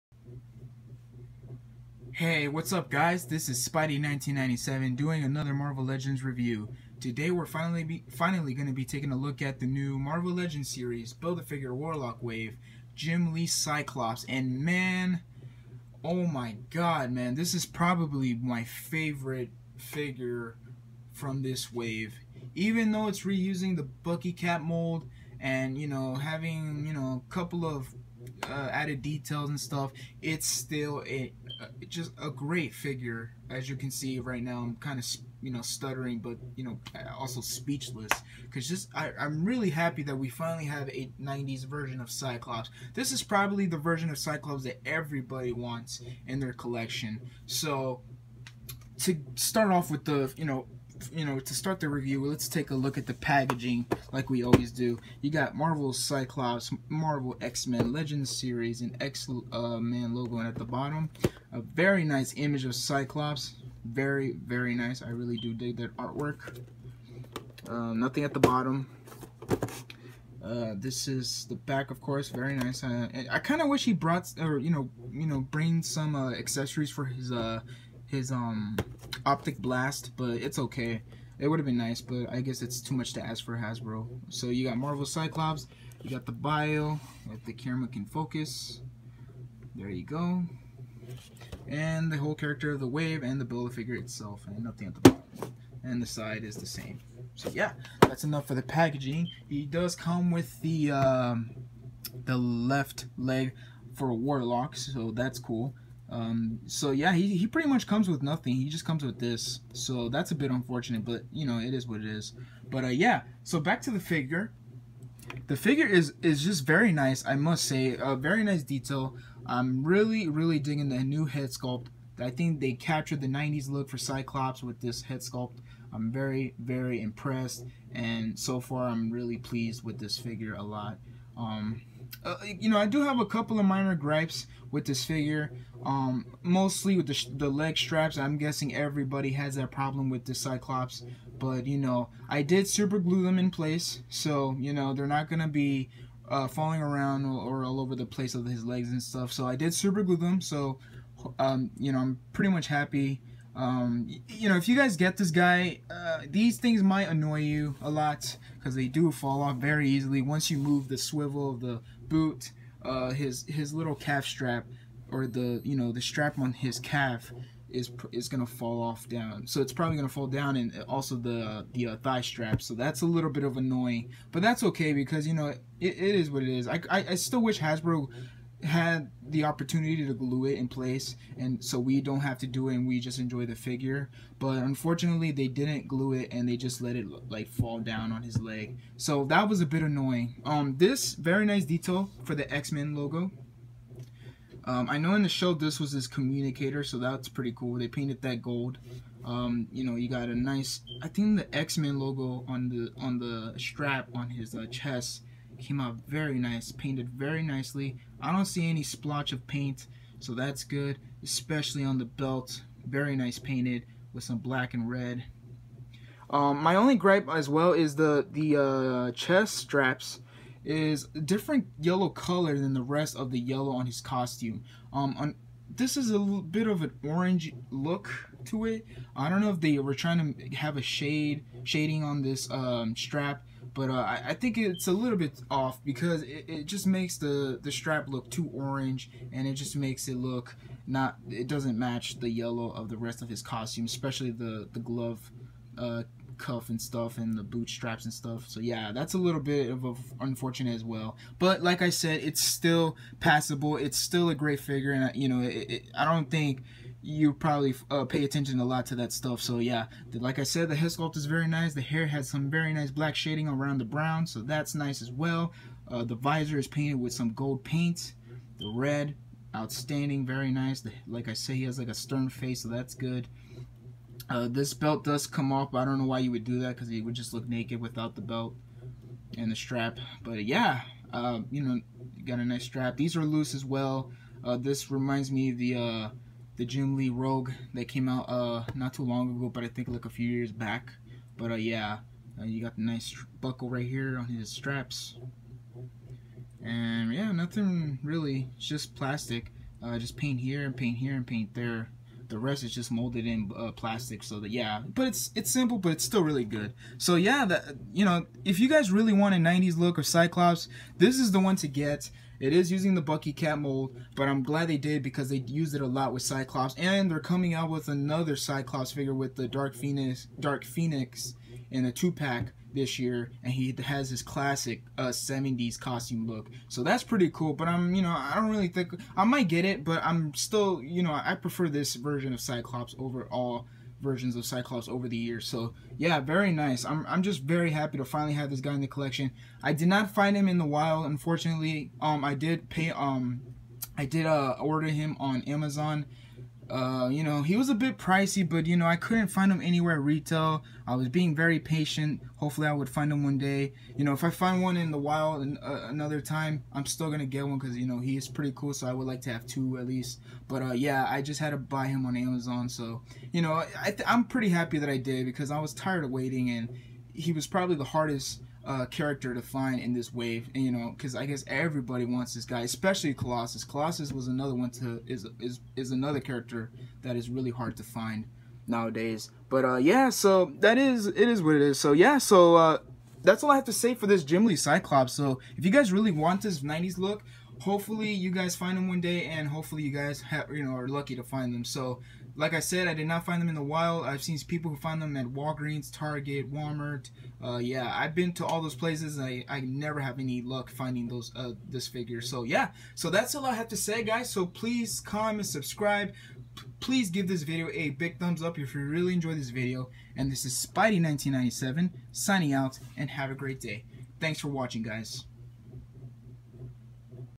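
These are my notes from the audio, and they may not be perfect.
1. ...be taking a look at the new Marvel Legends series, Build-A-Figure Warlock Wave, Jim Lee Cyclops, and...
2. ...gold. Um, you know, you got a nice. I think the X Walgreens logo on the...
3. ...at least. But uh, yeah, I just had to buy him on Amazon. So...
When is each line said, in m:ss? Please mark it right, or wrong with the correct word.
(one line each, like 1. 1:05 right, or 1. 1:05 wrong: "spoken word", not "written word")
1. 0:08 right
2. 3:18 wrong: "Men", not "Walgreens"
3. 5:59 right.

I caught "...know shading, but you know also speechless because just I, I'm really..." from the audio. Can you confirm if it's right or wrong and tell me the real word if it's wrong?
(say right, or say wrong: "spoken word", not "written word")
wrong: "stuttering", not "shading".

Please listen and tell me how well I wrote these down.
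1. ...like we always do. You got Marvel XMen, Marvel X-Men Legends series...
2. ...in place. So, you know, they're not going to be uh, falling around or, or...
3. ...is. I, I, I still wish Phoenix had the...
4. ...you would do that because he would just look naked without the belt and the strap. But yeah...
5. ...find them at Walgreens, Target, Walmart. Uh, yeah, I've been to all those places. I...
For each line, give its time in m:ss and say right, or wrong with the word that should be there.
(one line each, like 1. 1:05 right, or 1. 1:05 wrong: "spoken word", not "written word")
1. 0:54 wrong: "Cyclops", not "XMen"
2. 2:23 right
3. 2:56 wrong: "Hasbro", not "Phoenix"
4. 4:36 right
5. 6:34 right.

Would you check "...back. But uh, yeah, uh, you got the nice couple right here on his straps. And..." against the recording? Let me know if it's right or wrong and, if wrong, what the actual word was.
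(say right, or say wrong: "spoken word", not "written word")
wrong: "buckle", not "couple".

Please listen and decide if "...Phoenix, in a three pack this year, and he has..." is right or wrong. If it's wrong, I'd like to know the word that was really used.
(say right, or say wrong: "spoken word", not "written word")
wrong: "two", not "three".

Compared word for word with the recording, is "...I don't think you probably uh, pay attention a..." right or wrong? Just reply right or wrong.
right.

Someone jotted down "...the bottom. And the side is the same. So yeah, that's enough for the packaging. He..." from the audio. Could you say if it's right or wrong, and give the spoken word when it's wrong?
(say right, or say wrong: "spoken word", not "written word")
right.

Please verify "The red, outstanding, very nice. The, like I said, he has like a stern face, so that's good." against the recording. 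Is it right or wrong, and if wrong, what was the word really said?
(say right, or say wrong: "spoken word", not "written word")
right.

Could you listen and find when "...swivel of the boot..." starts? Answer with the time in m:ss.
2:40.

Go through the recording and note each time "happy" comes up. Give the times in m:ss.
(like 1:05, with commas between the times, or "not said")
0:39, 2:32, 5:37, 6:04.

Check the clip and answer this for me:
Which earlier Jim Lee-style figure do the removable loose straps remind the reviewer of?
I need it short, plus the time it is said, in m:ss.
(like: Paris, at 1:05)
Jim Lee Rogue, at 4:46.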